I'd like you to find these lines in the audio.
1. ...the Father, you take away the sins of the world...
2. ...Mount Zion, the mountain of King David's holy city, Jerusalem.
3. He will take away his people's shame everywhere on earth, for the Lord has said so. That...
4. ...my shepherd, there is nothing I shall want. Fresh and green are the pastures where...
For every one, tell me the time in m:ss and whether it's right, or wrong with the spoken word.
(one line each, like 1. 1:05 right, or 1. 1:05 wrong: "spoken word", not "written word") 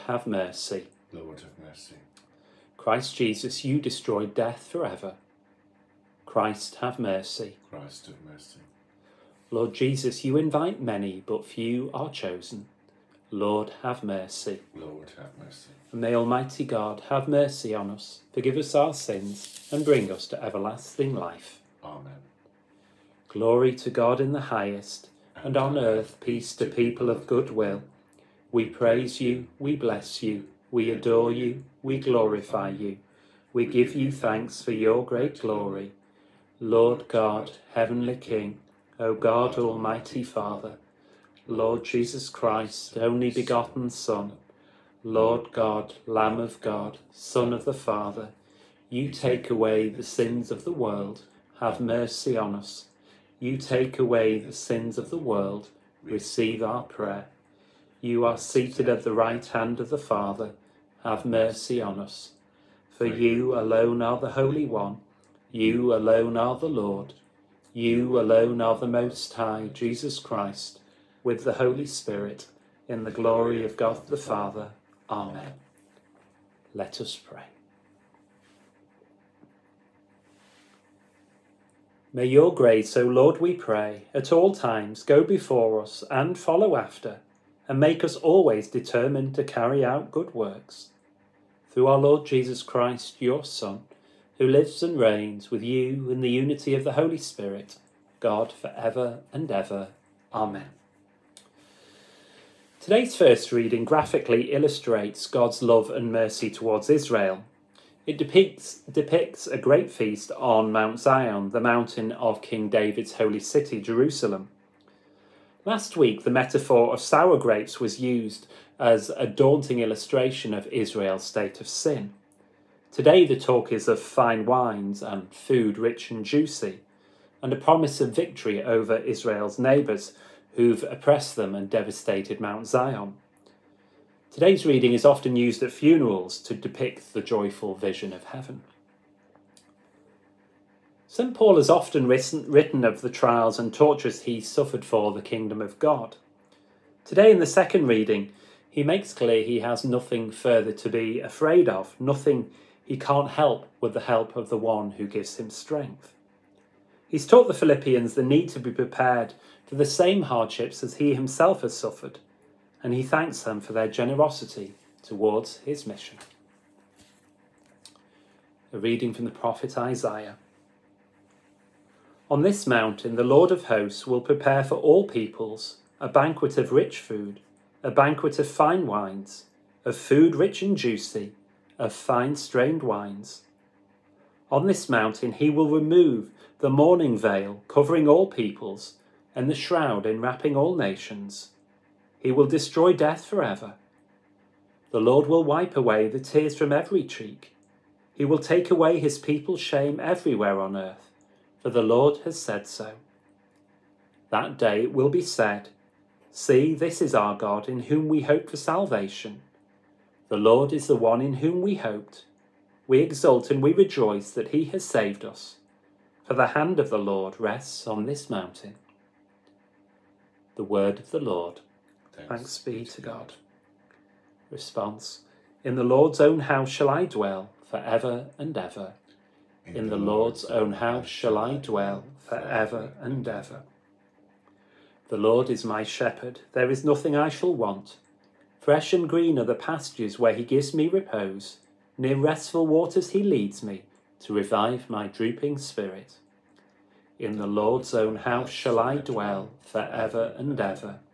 1. 0:47 right
2. 1:50 right
3. 3:18 right
4. 3:55 right.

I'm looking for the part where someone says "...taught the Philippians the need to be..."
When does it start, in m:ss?
2:37.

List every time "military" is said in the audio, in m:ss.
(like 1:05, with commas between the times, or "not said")
not said.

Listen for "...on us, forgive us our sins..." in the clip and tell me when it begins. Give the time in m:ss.
0:17.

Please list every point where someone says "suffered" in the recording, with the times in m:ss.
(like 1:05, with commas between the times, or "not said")
2:24, 2:41.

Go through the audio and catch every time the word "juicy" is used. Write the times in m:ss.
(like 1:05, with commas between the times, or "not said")
2:06, 3:00.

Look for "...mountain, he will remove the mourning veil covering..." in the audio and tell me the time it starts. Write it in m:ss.
3:04.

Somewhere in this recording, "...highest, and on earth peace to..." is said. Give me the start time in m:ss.
0:24.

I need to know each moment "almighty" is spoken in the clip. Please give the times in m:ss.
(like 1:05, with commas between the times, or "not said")
0:16, 0:39.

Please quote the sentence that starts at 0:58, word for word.
You are seated at the right hand of the Father, have mercy on us.